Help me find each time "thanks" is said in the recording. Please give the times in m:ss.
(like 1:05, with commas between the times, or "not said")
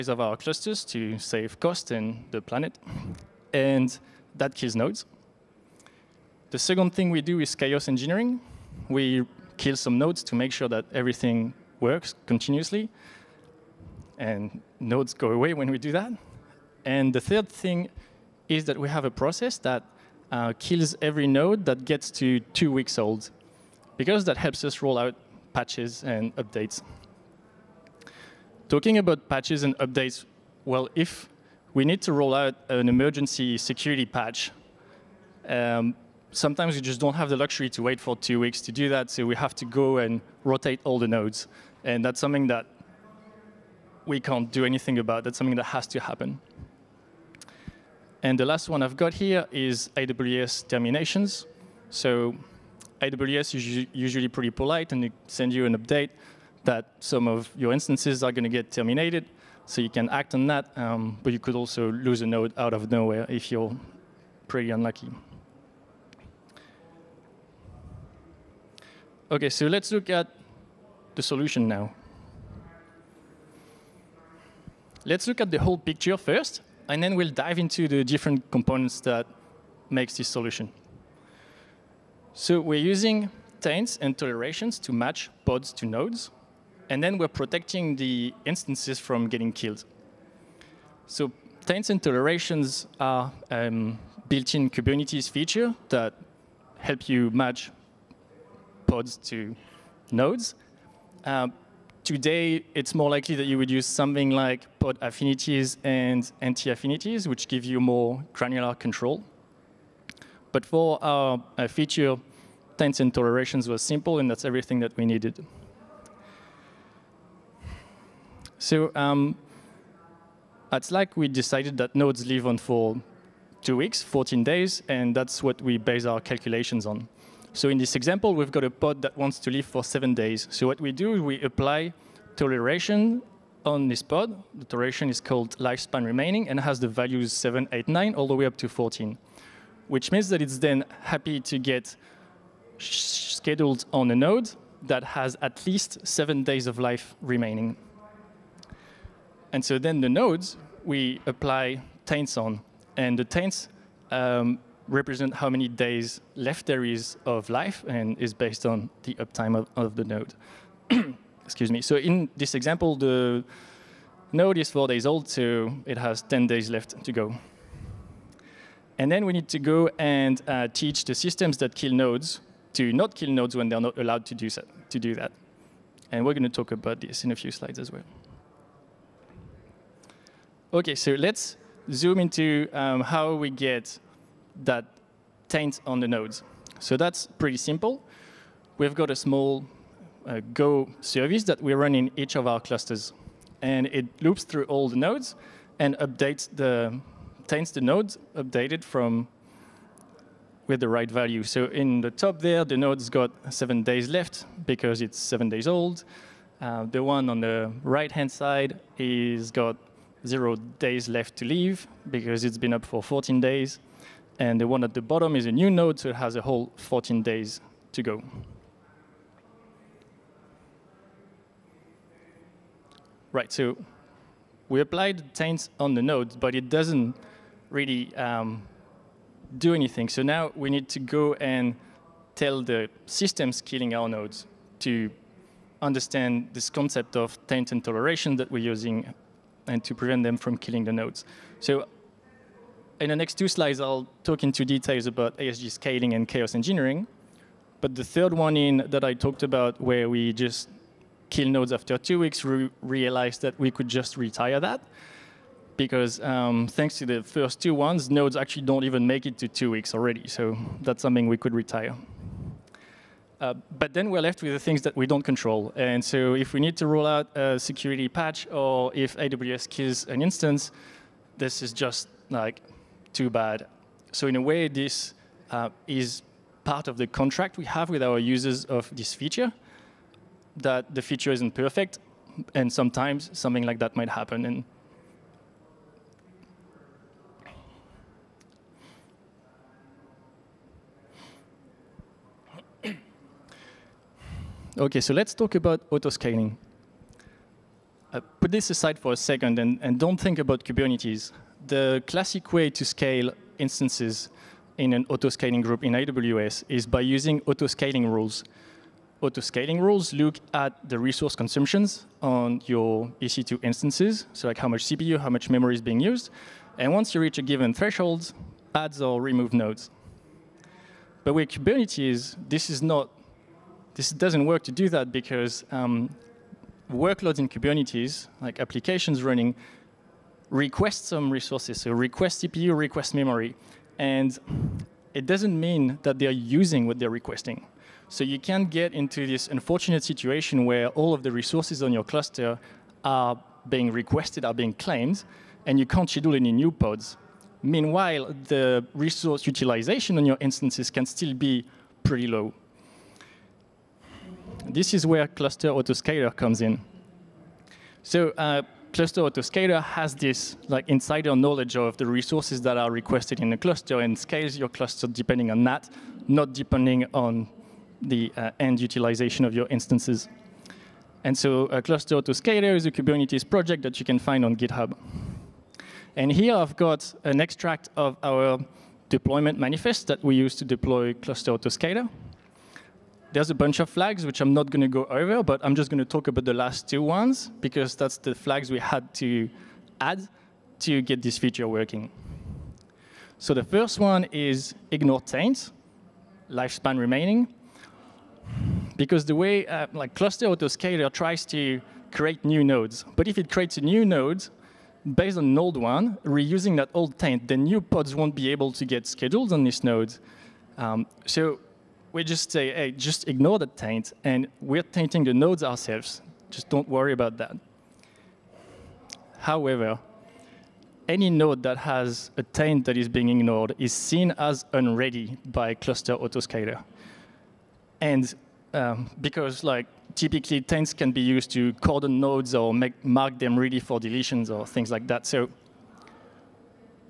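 4:16.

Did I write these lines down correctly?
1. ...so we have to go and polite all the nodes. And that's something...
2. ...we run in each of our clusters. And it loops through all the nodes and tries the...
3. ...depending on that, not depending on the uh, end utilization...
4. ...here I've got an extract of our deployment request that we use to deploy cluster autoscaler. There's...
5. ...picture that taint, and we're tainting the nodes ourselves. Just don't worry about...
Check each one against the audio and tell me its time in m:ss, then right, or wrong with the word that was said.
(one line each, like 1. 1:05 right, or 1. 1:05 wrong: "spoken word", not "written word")
1. 0:39 wrong: "rotate", not "polite"
2. 3:11 wrong: "updates", not "tries"
3. 6:05 right
4. 6:16 wrong: "manifest", not "request"
5. 6:53 wrong: "ignore", not "picture".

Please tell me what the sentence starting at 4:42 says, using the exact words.
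And sometimes something like that might happen.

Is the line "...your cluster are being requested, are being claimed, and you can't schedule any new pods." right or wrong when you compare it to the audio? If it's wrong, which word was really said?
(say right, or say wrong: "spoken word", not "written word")
right.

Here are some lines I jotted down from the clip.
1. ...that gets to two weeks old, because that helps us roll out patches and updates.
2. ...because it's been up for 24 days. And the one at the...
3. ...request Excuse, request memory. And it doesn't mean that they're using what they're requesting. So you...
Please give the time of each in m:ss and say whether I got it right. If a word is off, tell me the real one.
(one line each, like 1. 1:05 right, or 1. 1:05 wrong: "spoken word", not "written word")
1. 0:21 right
2. 3:32 wrong: "14", not "24"
3. 5:31 wrong: "CPU", not "Excuse".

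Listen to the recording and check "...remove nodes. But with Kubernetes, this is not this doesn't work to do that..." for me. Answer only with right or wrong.
right.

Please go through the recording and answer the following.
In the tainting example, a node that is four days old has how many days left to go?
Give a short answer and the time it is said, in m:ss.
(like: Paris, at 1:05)
10, at 2:46.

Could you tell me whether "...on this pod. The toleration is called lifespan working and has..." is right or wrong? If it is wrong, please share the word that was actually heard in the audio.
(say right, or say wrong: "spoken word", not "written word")
wrong: "remaining", not "working".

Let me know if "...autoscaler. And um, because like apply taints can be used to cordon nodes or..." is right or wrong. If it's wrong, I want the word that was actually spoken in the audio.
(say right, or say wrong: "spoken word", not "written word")
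wrong: "typically", not "apply".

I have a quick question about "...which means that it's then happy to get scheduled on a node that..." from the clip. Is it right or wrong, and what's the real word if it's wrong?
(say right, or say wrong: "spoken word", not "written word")
right.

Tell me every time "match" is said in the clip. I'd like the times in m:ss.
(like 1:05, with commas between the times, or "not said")
1:24, 1:37.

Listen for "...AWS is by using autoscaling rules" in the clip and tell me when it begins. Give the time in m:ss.
5:05.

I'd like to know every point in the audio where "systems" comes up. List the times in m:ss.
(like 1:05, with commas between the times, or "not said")
2:51, 3:53.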